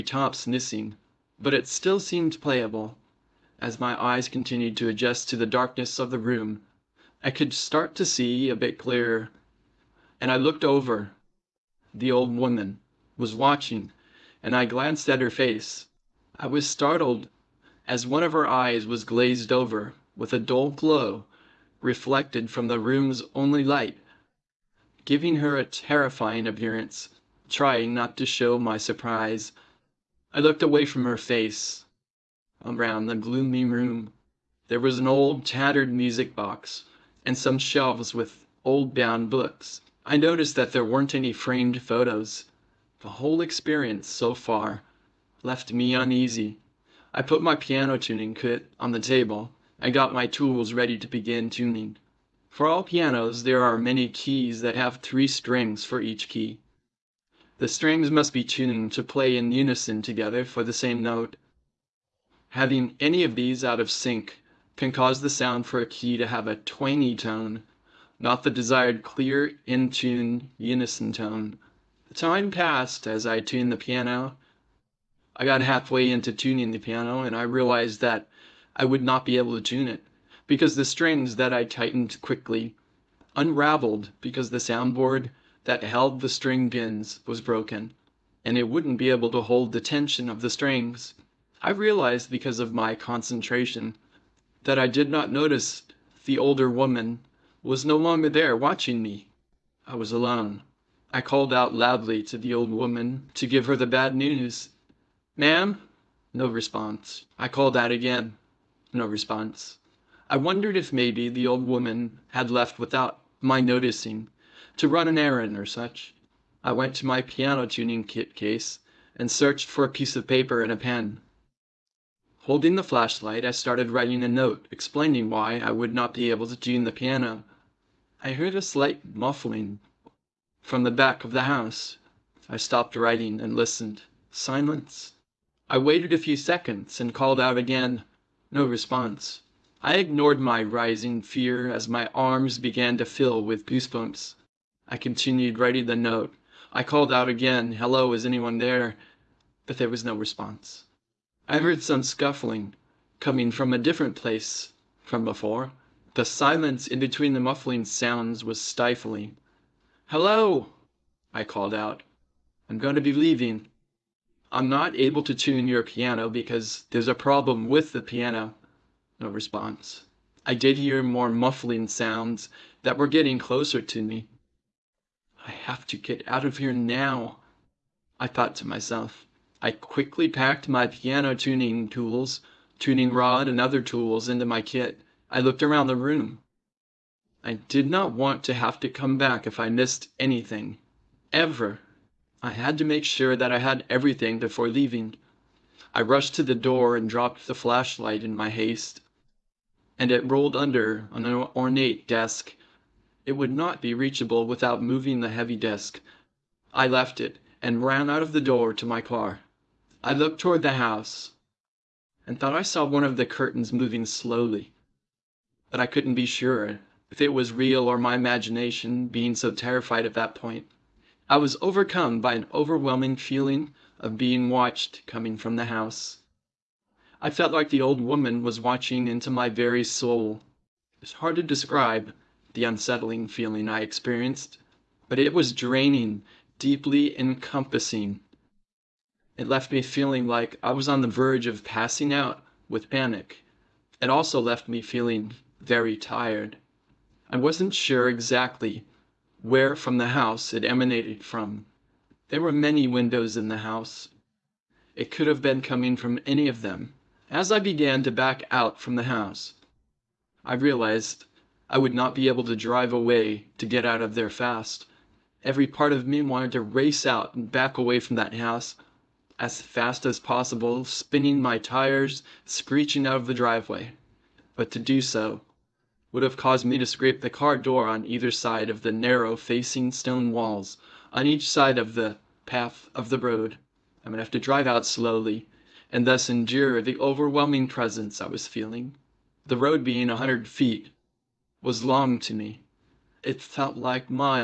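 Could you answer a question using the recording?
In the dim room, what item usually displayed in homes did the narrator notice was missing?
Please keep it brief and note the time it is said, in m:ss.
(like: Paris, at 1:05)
framed photos, at 0:41.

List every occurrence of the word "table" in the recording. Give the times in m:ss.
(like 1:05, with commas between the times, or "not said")
0:48.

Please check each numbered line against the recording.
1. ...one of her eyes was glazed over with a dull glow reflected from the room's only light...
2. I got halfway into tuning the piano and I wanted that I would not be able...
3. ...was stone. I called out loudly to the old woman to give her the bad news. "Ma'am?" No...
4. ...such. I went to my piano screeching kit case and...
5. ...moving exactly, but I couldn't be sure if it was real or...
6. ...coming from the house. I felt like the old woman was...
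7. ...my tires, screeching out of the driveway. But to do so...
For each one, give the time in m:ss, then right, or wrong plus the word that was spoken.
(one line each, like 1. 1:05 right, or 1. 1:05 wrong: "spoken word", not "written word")
1. 0:18 right
2. 1:15 wrong: "realized", not "wanted"
3. 1:39 wrong: "alone", not "stone"
4. 1:55 wrong: "tuning", not "screeching"
5. 3:33 wrong: "slowly", not "exactly"
6. 3:45 right
7. 4:31 right.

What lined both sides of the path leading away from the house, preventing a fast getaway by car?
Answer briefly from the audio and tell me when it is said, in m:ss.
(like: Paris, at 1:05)
stone walls, at 4:39.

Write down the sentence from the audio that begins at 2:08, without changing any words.
I heard a slight muffling from the back of the house.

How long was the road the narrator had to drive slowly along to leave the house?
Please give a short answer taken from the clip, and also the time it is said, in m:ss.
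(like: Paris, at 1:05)
100 feet, at 4:50.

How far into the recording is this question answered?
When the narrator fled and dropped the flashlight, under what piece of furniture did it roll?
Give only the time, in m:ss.
3:21.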